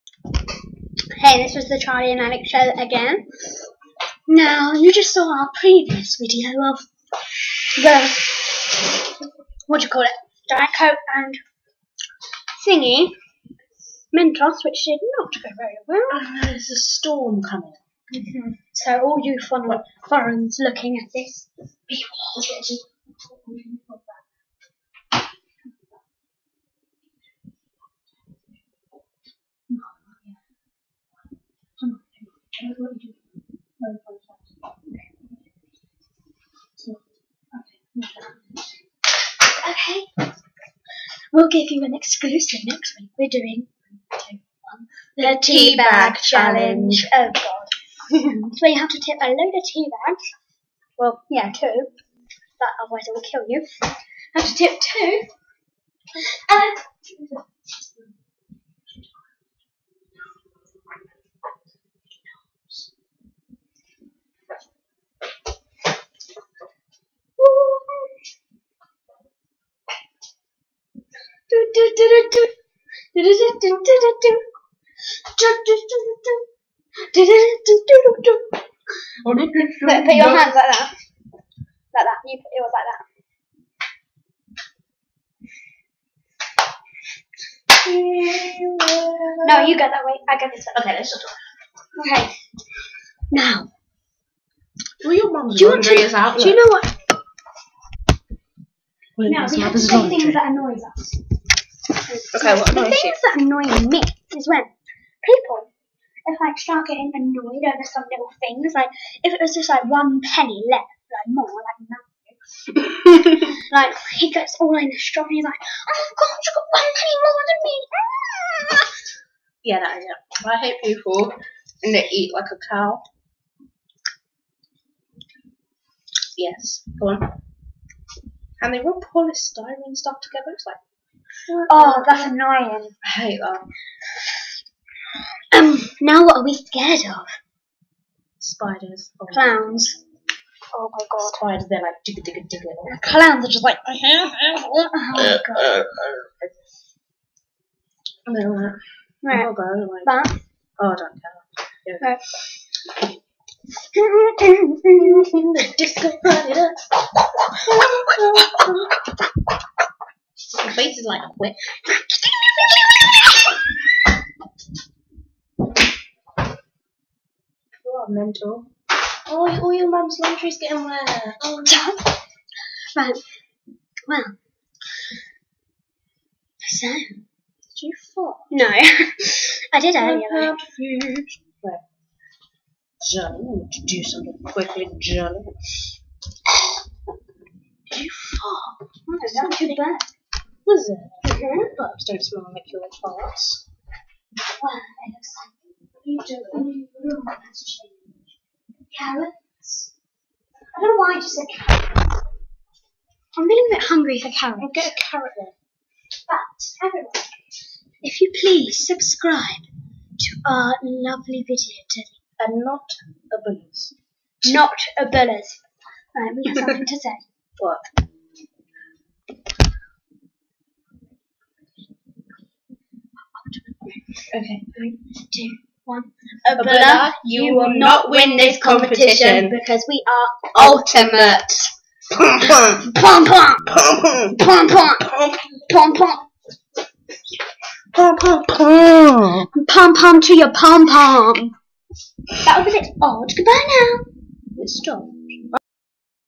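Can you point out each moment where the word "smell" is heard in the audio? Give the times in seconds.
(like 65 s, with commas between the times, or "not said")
192 s.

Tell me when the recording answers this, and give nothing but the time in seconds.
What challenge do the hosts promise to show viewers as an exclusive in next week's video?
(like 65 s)
45 s.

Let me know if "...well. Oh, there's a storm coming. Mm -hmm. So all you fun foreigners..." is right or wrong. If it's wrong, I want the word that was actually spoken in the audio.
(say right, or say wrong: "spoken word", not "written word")
right.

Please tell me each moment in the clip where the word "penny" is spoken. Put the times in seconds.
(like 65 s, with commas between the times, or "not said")
110 s, 118 s.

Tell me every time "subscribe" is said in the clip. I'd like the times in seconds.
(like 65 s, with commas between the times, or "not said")
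208 s.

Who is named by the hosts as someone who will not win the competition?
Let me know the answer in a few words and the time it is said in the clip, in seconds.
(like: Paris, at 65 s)
Abdullah, at 226 s.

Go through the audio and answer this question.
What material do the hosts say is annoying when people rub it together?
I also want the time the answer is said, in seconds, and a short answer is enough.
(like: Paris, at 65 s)
polystyrene, at 129 s.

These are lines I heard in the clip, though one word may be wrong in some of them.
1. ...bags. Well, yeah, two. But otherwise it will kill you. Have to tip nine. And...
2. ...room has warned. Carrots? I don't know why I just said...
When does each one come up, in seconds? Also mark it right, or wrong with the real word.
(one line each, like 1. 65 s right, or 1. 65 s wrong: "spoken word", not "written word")
1. 50 s wrong: "two", not "nine"
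2. 197 s wrong: "changed", not "warned".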